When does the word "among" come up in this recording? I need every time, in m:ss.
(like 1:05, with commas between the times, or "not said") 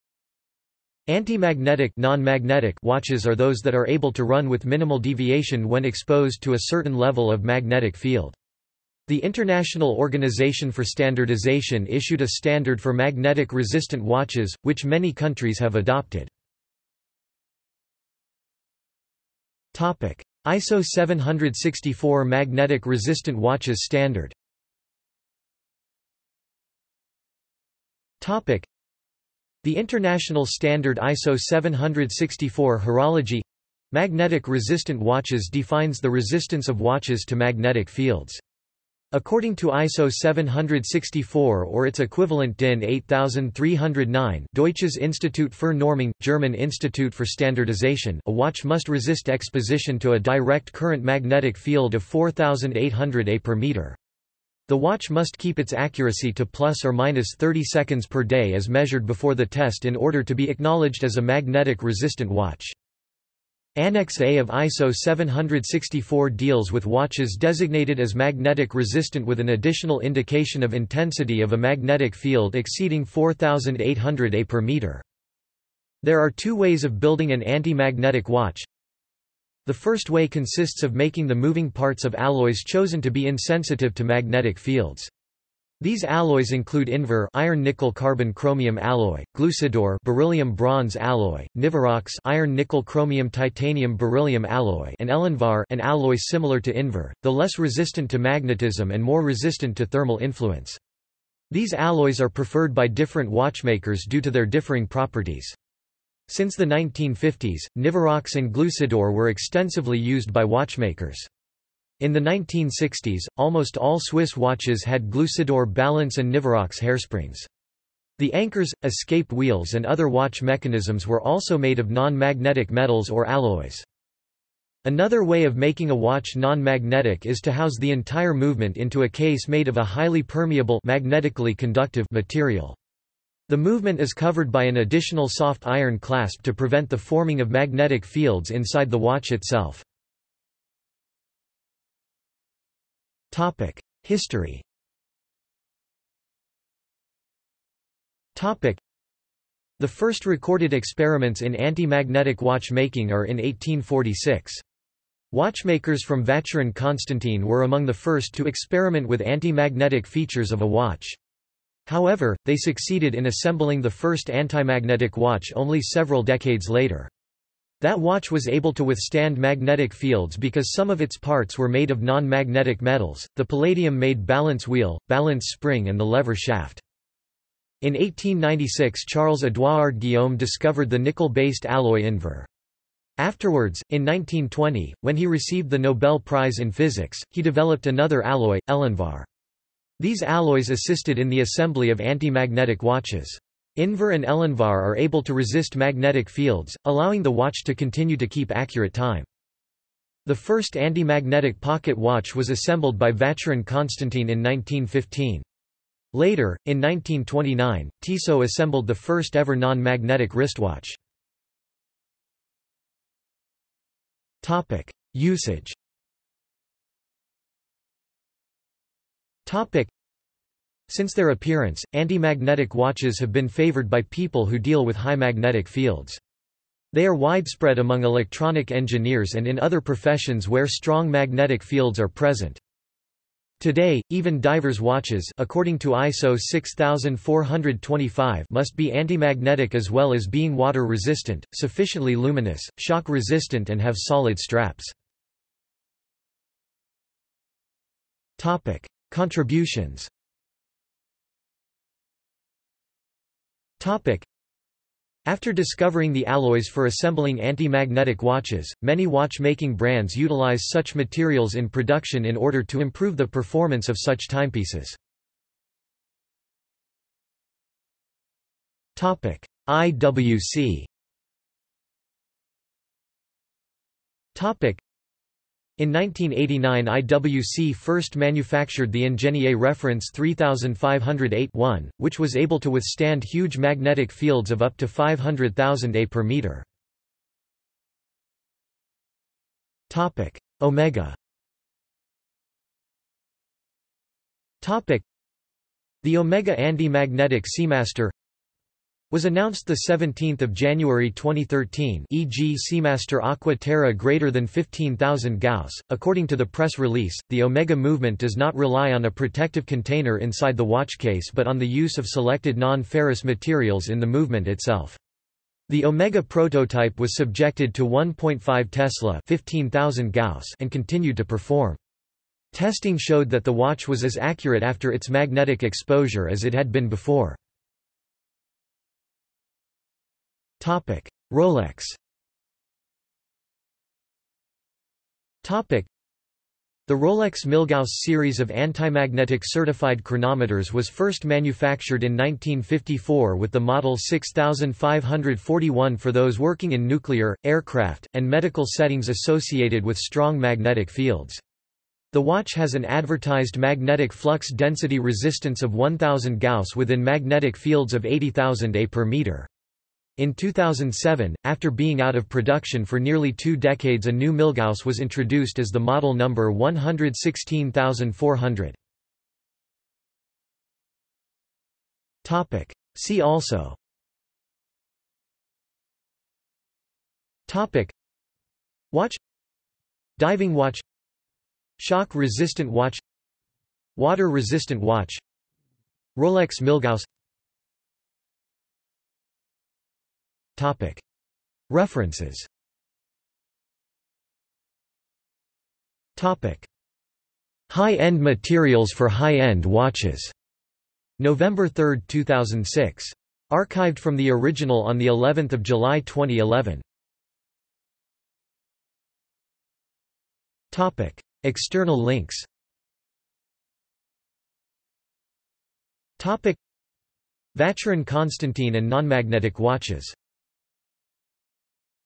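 2:37, 3:47.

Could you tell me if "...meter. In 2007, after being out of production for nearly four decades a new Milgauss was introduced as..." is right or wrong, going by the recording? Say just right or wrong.
wrong.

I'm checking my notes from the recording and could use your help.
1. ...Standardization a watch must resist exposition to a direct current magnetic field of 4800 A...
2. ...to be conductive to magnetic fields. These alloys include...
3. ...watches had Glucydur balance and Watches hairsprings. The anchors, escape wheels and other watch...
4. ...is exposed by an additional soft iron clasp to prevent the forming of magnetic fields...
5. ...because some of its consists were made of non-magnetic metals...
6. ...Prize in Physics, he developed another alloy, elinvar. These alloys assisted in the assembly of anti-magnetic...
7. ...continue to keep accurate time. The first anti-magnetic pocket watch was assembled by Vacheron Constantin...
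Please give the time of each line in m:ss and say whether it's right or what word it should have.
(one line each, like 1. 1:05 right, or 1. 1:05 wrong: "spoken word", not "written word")
1. 0:47 right
2. 1:23 wrong: "insensitive", not "conductive"
3. 1:54 wrong: "Nivarox", not "Watches"
4. 2:13 wrong: "covered", not "exposed"
5. 2:50 wrong: "parts", not "consists"
6. 3:06 right
7. 3:17 right.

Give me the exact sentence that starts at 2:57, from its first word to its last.
In 1896 Charles-Édouard Guillaume discovered the nickel-based alloy invar.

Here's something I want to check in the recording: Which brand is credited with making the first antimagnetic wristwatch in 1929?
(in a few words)
Tissot.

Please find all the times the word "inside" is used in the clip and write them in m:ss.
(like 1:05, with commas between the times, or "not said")
2:18, 5:10.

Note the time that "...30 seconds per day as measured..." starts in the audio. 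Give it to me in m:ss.
0:57.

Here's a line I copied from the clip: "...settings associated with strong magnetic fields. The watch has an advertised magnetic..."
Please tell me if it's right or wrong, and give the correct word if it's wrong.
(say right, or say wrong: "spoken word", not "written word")
right.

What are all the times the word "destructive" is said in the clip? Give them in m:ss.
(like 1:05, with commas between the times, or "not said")
not said.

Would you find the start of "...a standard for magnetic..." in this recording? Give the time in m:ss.
0:12.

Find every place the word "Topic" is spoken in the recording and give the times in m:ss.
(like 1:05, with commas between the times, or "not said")
5:30, 5:35, 6:17, 6:50, 6:56.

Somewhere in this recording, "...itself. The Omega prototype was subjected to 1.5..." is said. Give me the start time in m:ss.
5:14.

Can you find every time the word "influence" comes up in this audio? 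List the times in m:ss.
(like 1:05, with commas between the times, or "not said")
1:40.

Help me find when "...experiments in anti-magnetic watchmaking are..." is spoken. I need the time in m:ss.
2:30.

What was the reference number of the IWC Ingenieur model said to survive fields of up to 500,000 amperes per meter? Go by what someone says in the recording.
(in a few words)
3508-1.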